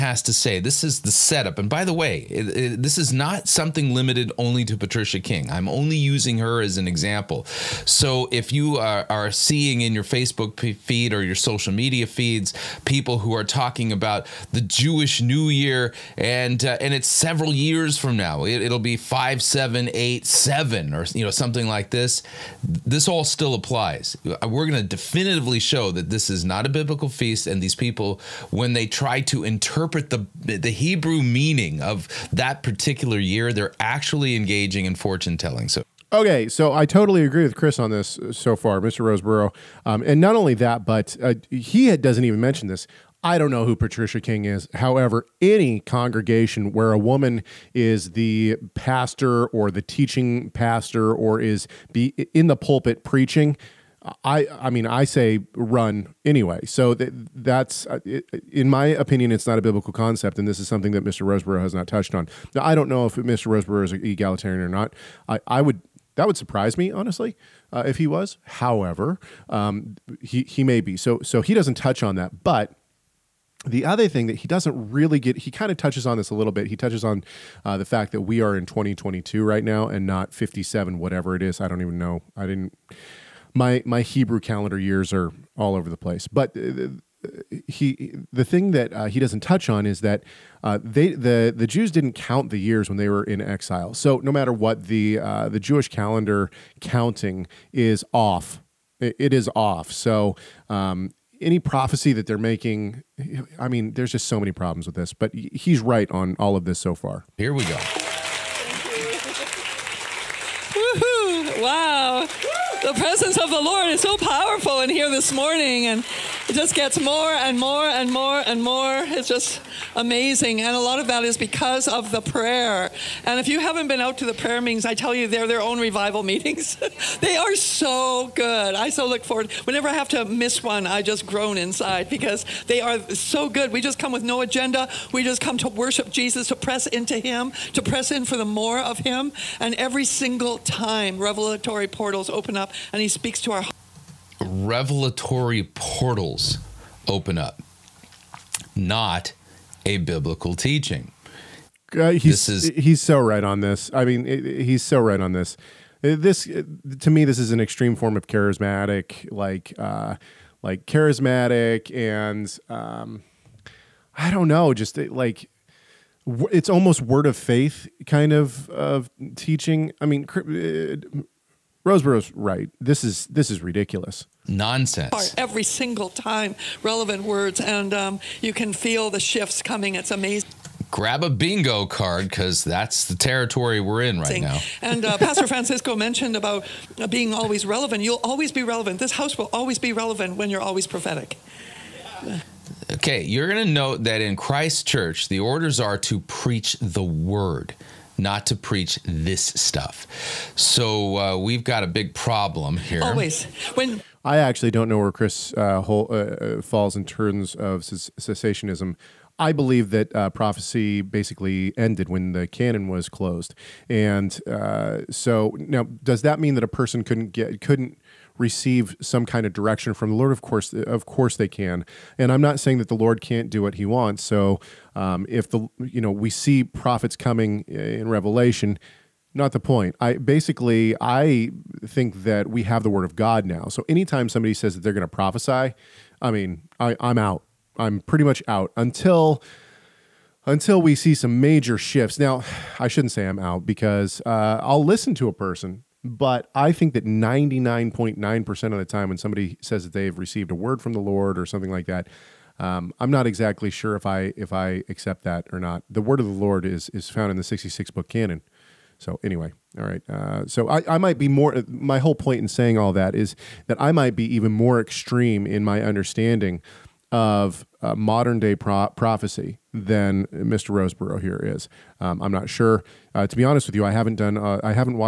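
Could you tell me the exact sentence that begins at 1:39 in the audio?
So um, any prophecy that they're making, I mean, there's just so many problems with this.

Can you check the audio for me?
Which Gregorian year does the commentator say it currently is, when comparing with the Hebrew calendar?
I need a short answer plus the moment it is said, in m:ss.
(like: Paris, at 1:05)
2022, at 1:18.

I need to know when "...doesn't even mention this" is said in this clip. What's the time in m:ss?
0:41.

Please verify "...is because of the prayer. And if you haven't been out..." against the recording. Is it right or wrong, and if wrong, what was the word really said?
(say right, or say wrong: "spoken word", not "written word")
right.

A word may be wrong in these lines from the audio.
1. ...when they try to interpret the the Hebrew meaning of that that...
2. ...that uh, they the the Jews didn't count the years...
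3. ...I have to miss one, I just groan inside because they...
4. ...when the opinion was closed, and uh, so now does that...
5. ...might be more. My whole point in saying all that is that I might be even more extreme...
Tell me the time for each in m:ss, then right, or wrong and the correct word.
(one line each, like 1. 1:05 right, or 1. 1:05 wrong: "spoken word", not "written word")
1. 0:28 right
2. 1:29 right
3. 2:09 right
4. 3:32 wrong: "canon", not "opinion"
5. 4:20 right.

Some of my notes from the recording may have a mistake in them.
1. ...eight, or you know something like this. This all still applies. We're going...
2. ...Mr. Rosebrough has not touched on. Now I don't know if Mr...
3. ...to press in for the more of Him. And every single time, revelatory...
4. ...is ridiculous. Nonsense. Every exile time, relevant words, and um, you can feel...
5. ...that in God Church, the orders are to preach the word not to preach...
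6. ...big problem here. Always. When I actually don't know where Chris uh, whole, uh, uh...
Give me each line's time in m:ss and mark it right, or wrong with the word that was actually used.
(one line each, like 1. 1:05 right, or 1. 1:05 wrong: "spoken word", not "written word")
1. 0:20 wrong: "seven", not "eight"
2. 1:01 right
3. 2:17 right
4. 2:53 wrong: "single", not "exile"
5. 3:14 wrong: "Christ", not "God"
6. 3:21 right.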